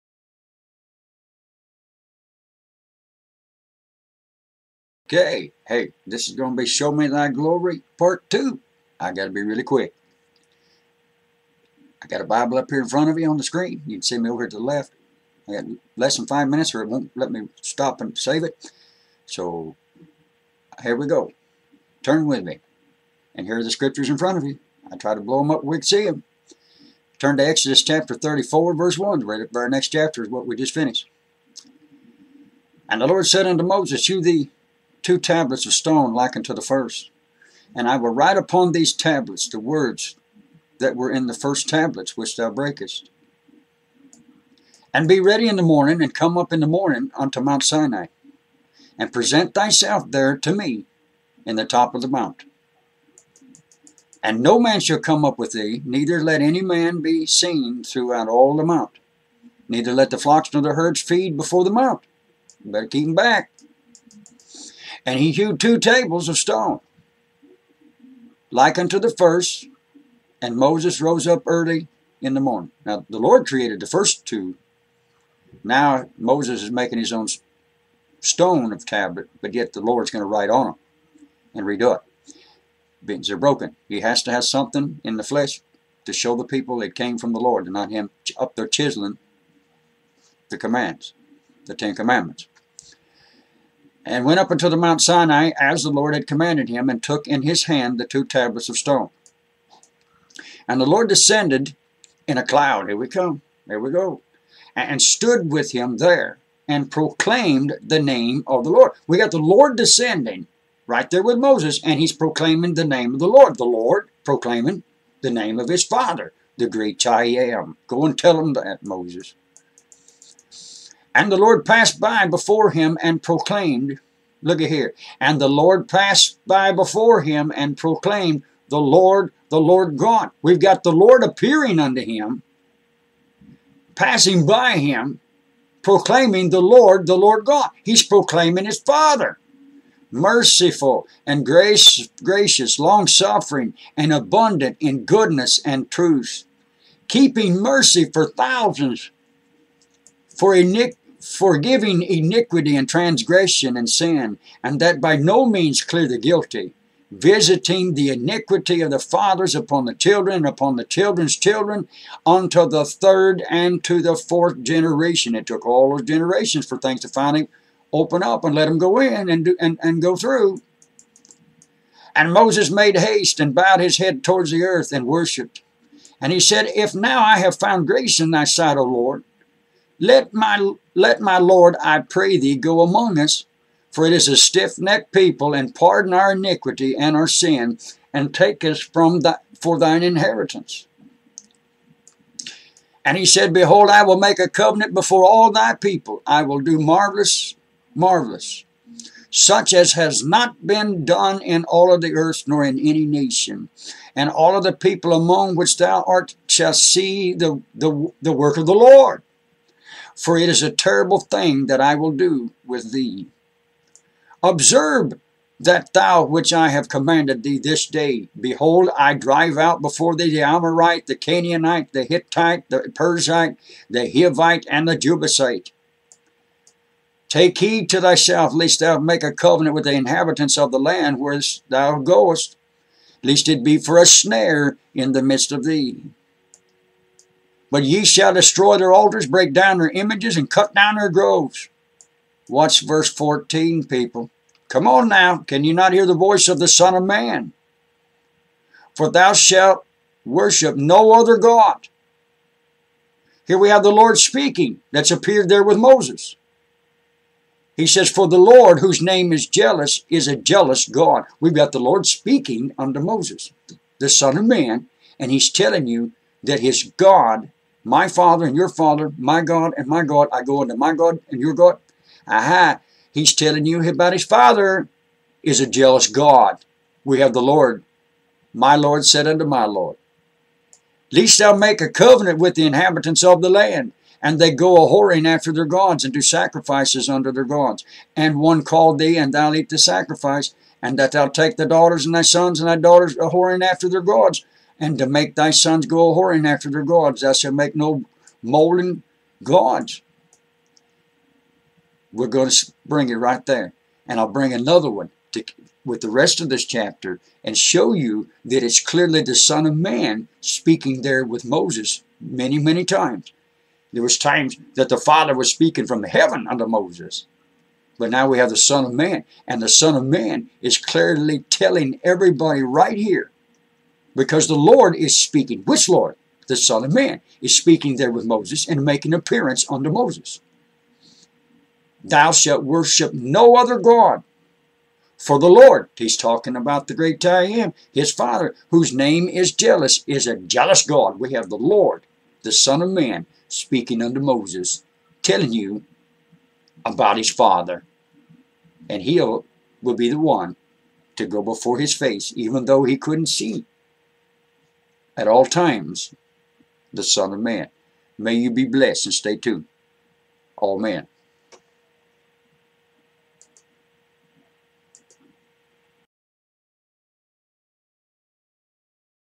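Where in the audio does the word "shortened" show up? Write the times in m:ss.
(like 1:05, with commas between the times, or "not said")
not said.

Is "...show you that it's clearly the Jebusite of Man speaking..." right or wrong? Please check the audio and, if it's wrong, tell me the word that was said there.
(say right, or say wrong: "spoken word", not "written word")
wrong: "Son", not "Jebusite".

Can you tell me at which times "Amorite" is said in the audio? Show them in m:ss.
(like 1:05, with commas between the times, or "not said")
3:40.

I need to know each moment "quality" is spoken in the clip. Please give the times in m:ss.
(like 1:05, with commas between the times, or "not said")
not said.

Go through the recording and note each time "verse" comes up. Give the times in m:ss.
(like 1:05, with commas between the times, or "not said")
0:28, 4:02.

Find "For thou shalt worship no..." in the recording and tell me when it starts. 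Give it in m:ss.
4:08.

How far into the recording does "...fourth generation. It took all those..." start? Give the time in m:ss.
2:44.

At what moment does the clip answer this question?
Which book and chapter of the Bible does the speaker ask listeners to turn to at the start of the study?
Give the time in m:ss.
0:27.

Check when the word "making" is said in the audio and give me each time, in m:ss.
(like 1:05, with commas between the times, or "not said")
1:16, 5:28.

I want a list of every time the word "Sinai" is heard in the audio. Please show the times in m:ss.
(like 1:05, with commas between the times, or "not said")
0:47, 1:35.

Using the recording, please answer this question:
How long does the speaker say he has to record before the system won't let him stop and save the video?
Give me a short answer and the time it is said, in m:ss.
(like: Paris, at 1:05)
less than 5 minutes, at 0:15.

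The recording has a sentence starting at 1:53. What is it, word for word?
The Lord proclaiming the name of his father, the great I am.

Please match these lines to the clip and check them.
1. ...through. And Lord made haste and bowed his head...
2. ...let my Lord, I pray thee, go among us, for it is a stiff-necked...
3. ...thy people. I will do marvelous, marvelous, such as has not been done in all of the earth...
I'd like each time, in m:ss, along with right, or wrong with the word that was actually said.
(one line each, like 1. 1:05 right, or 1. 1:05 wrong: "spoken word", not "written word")
1. 2:50 wrong: "Moses", not "Lord"
2. 3:00 right
3. 3:15 right.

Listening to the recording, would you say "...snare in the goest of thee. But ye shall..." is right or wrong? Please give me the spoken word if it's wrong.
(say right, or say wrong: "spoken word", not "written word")
wrong: "midst", not "goest".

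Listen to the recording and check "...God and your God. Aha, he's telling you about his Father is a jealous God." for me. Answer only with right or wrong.
right.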